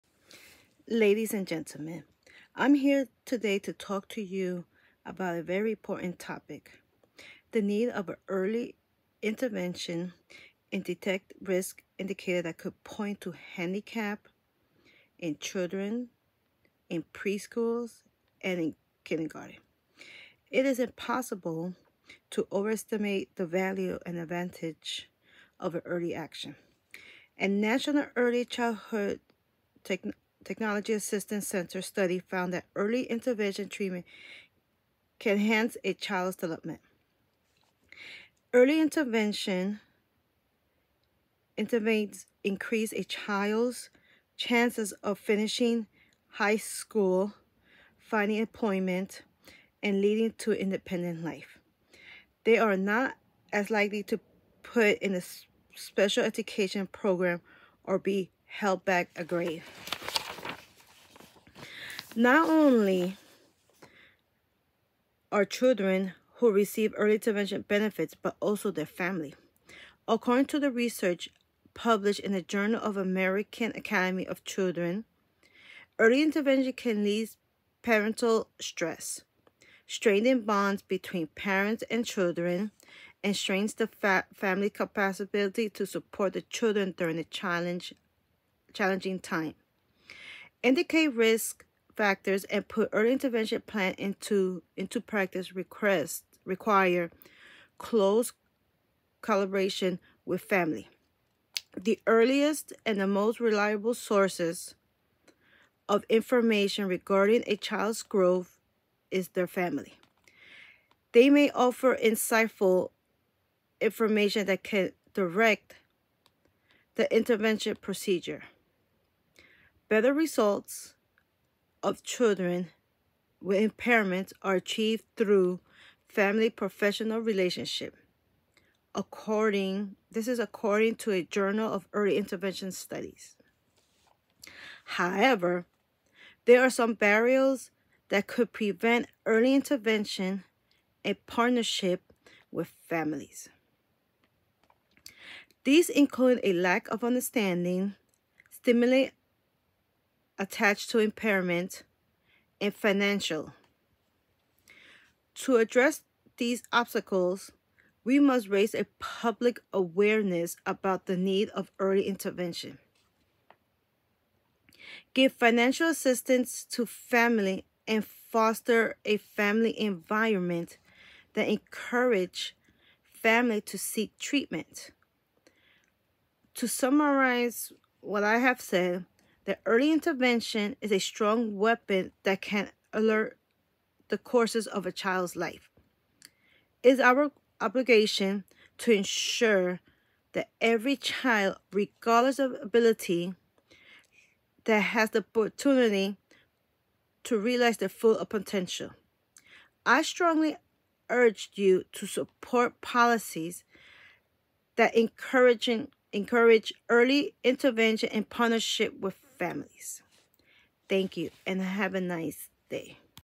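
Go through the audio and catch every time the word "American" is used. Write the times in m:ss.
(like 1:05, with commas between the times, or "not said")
1:12.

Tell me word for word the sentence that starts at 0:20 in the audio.
It is impossible to overestimate the value and advantage of an early action.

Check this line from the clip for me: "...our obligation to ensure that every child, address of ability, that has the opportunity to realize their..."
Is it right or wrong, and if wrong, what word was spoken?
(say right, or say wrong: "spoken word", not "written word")
wrong: "regardless", not "address".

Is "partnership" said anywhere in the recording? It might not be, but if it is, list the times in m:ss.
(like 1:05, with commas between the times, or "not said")
2:21, 3:28.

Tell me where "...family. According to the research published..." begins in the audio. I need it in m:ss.
1:08.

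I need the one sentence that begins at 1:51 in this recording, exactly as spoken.
They may offer insightful information that can direct the intervention procedure.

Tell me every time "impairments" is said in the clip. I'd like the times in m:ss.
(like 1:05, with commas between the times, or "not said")
2:03, 2:30.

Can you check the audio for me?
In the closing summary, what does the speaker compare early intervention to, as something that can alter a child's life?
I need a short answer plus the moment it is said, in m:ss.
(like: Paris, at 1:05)
a strong weapon, at 3:00.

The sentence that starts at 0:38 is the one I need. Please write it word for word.
Early intervention intervenes increase a child's chances of finishing high school, finding employment, and leading to independent life.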